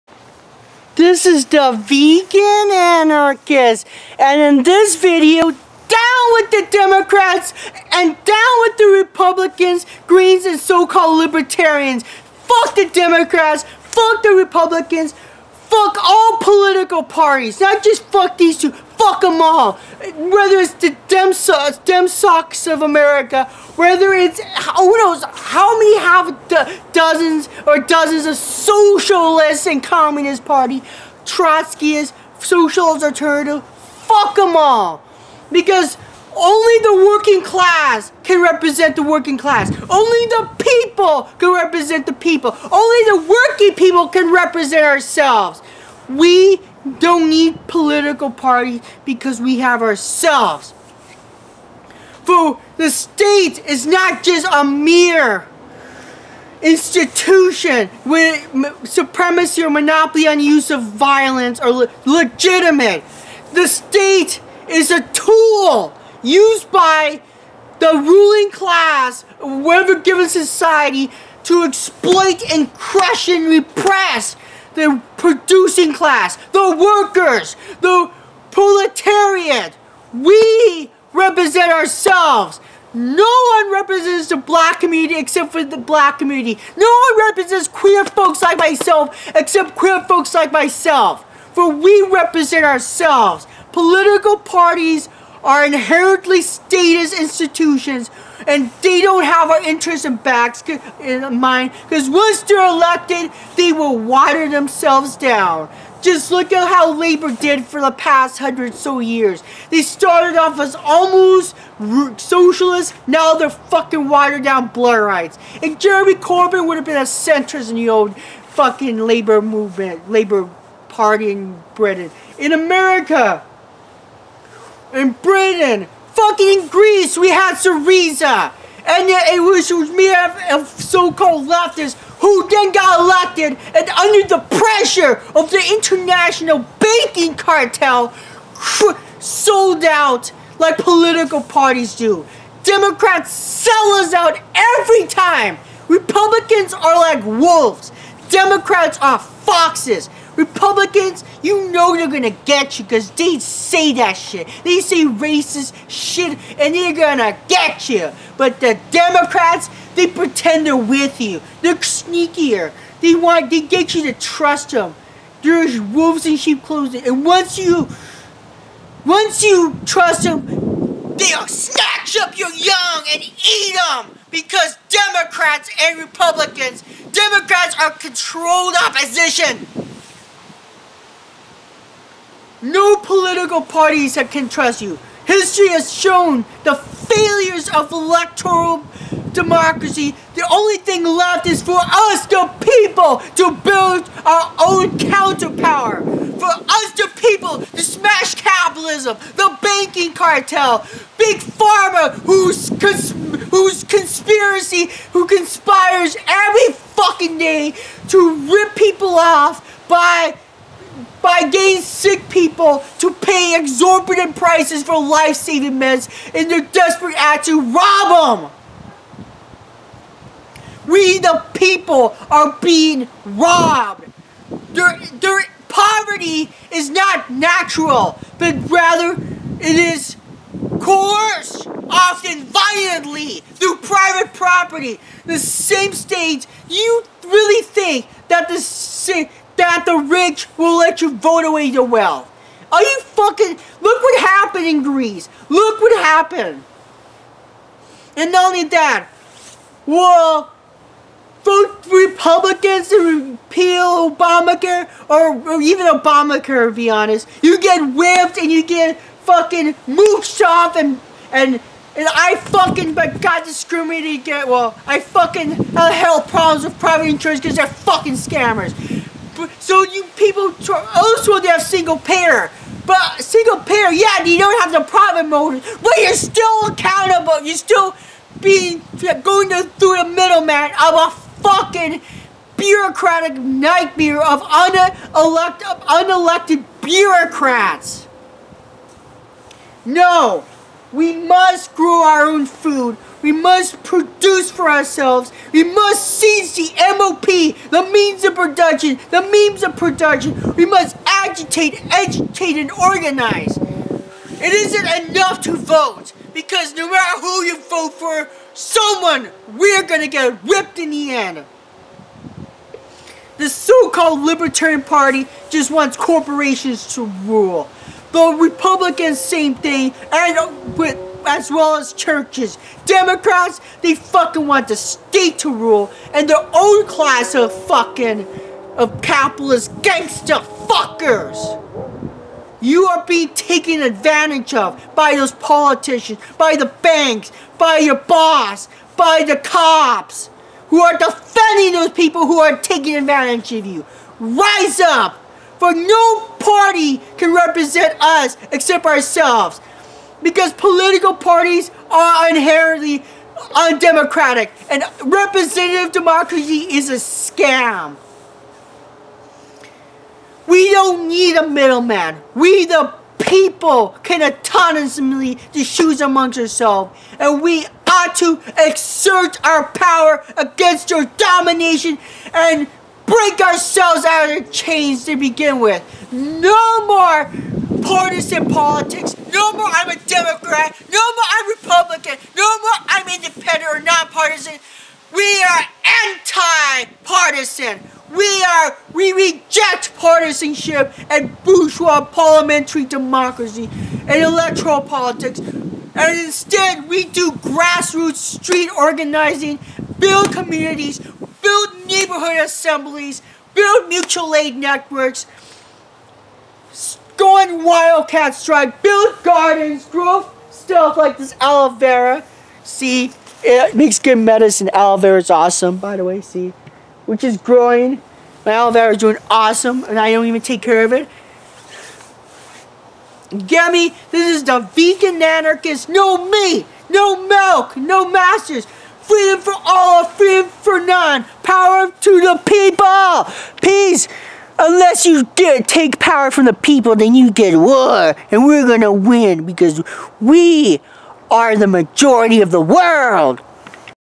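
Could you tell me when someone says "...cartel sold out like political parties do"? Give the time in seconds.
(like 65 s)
137 s.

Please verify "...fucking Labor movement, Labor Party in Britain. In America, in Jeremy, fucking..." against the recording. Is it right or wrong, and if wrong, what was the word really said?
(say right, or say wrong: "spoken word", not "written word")
wrong: "Britain", not "Jeremy".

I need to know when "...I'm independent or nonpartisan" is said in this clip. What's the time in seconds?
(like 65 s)
382 s.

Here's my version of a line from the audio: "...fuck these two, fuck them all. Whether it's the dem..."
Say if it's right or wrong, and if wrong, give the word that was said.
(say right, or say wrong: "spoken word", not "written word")
right.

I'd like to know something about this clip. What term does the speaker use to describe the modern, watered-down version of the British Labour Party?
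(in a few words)
Blairites.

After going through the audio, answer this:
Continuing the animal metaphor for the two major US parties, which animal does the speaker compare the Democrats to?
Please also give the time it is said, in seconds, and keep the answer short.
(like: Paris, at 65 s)
Foxes, at 149 s.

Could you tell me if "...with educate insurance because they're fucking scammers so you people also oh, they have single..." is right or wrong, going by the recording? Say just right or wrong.
wrong.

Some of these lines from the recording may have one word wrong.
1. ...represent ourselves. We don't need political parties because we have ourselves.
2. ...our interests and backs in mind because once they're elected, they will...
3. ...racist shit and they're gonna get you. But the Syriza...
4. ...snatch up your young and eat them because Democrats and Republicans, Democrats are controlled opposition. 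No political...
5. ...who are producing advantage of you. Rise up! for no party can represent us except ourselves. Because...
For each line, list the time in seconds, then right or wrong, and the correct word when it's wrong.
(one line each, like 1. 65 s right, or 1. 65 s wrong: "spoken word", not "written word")
1. 44 s right
2. 99 s right
3. 155 s wrong: "Democrats", not "Syriza"
4. 171 s right
5. 342 s wrong: "taking", not "producing".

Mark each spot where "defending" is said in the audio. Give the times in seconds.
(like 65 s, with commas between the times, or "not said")
340 s.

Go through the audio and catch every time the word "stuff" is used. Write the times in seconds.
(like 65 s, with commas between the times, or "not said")
410 s.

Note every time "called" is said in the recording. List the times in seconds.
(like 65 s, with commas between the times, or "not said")
10 s, 130 s, 313 s.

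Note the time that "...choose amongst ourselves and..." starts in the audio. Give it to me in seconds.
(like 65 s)
365 s.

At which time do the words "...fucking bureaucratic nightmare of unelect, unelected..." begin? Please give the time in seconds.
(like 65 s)
281 s.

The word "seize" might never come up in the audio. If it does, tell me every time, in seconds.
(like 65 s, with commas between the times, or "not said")
296 s.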